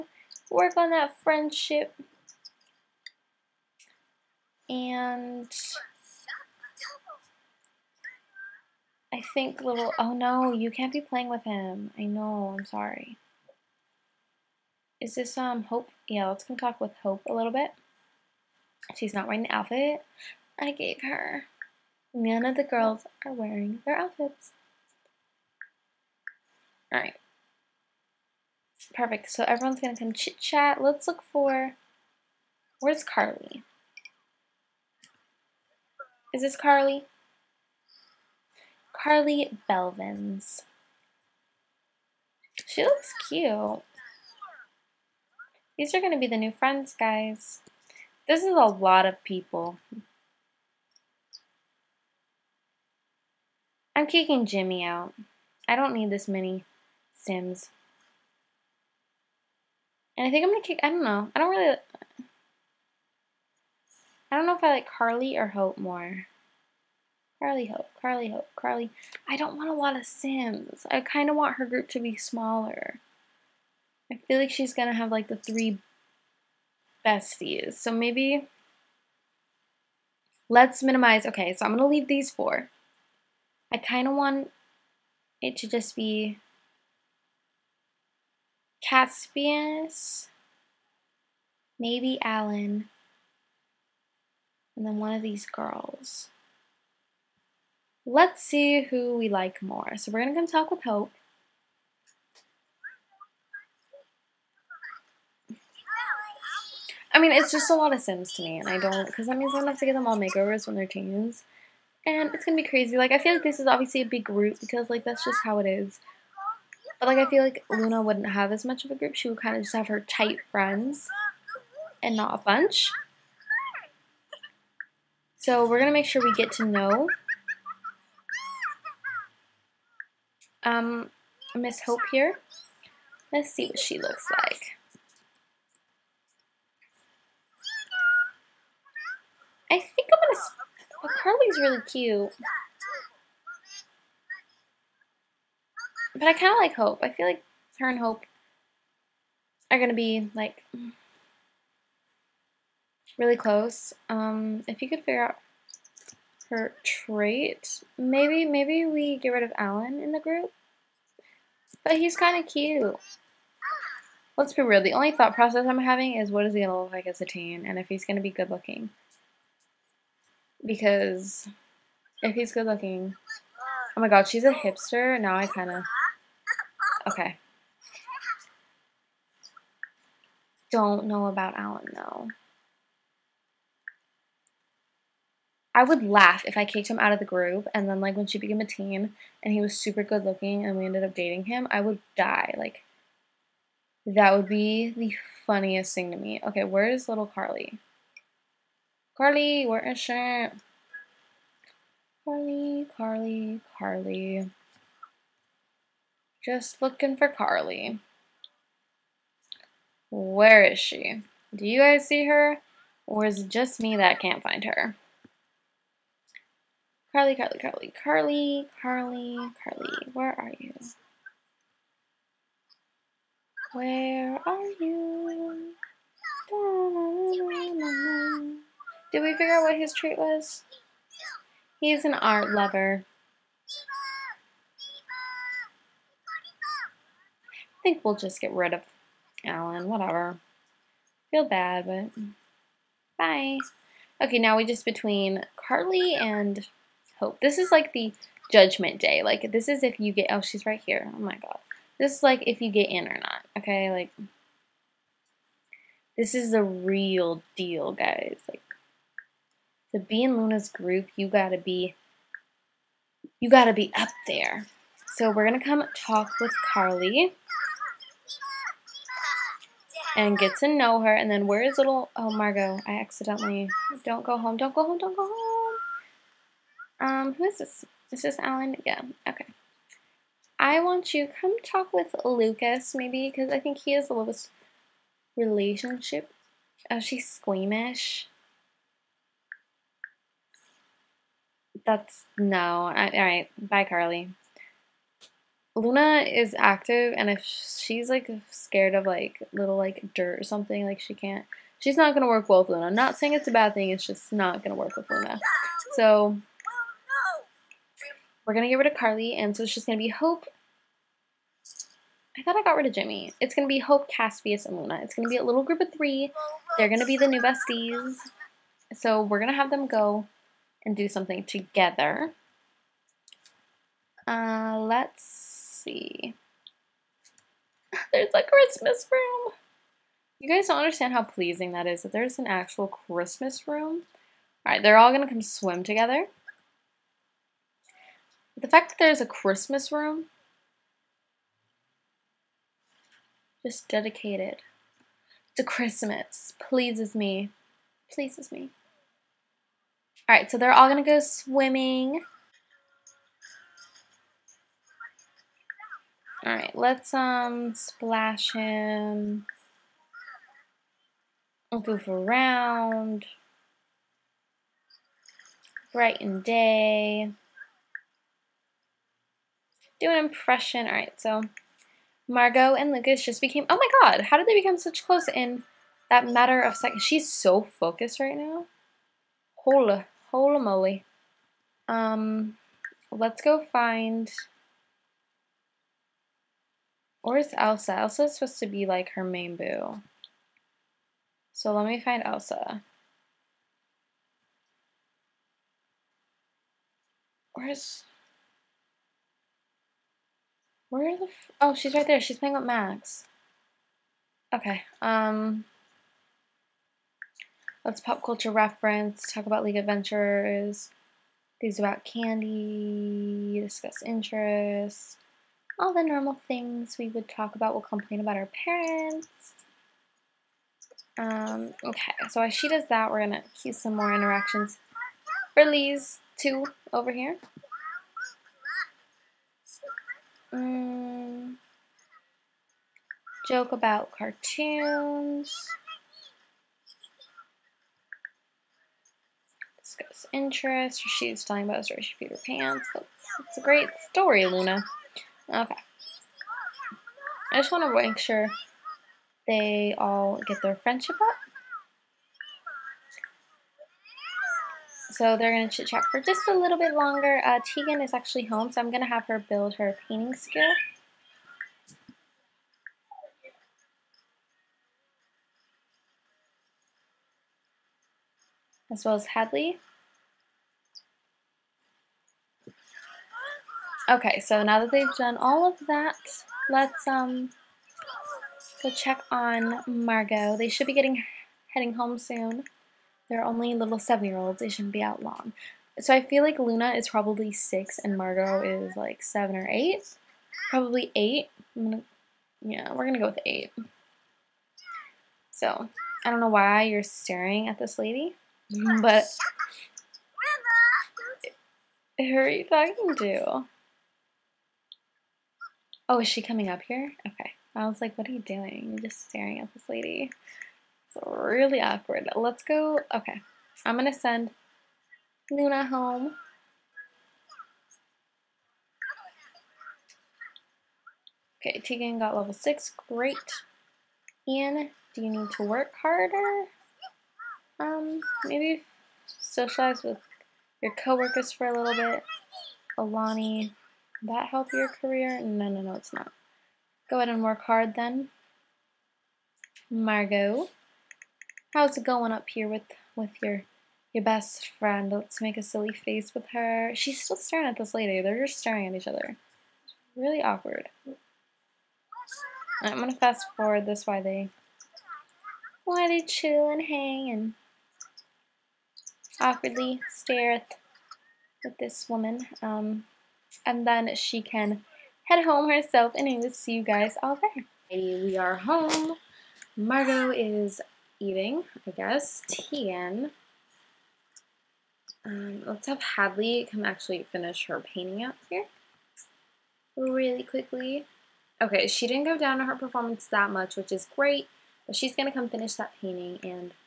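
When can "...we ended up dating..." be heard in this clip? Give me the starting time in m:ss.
3:10.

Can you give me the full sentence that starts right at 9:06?
She's still staring at this lady.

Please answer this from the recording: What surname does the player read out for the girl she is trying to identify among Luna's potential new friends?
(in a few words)
Belvins.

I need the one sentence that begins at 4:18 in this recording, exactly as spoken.
Like to be in Luna's group, you gotta be you gotta be up there.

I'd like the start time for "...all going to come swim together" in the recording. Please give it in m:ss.
5:34.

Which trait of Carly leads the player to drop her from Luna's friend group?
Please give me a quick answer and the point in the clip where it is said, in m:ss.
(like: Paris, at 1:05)
Squeamish, at 4:46.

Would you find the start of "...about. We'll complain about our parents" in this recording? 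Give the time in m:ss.
6:57.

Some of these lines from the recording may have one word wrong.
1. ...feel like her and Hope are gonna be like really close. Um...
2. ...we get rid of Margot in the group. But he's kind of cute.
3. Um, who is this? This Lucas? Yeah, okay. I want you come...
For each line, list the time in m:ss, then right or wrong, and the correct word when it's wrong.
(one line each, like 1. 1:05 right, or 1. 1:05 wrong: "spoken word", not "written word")
1. 2:27 right
2. 2:38 wrong: "Alan", not "Margot"
3. 4:36 wrong: "Alan", not "Lucas".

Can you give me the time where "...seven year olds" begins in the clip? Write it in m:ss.
8:03.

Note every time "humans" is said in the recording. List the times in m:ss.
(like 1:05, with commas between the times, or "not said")
not said.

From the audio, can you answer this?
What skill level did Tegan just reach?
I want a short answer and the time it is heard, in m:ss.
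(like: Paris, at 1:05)
6, at 8:42.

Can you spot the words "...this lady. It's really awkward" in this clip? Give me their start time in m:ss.
8:29.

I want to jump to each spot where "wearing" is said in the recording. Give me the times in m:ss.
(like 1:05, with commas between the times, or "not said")
0:19, 0:23.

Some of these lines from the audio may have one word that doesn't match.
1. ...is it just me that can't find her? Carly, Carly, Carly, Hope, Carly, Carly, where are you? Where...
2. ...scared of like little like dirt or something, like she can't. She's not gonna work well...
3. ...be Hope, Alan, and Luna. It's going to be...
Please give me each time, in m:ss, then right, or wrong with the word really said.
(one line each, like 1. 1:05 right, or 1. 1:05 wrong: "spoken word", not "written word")
1. 3:33 wrong: "Carly", not "Hope"
2. 4:58 right
3. 5:13 wrong: "Caspius", not "Alan".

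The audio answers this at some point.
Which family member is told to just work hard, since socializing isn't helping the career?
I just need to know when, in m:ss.
8:52.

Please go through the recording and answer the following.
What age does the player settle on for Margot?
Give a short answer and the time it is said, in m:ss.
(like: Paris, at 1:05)
8, at 8:12.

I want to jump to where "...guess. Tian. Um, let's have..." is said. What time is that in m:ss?
9:31.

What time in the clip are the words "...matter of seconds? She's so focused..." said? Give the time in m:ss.
6:16.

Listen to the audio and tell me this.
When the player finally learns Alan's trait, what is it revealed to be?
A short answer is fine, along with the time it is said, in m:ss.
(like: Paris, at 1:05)
Art lover, at 3:51.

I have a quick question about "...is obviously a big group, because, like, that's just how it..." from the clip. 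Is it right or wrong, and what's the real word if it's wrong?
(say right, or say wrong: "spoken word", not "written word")
right.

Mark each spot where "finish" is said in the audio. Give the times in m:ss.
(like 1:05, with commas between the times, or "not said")
9:37, 9:45.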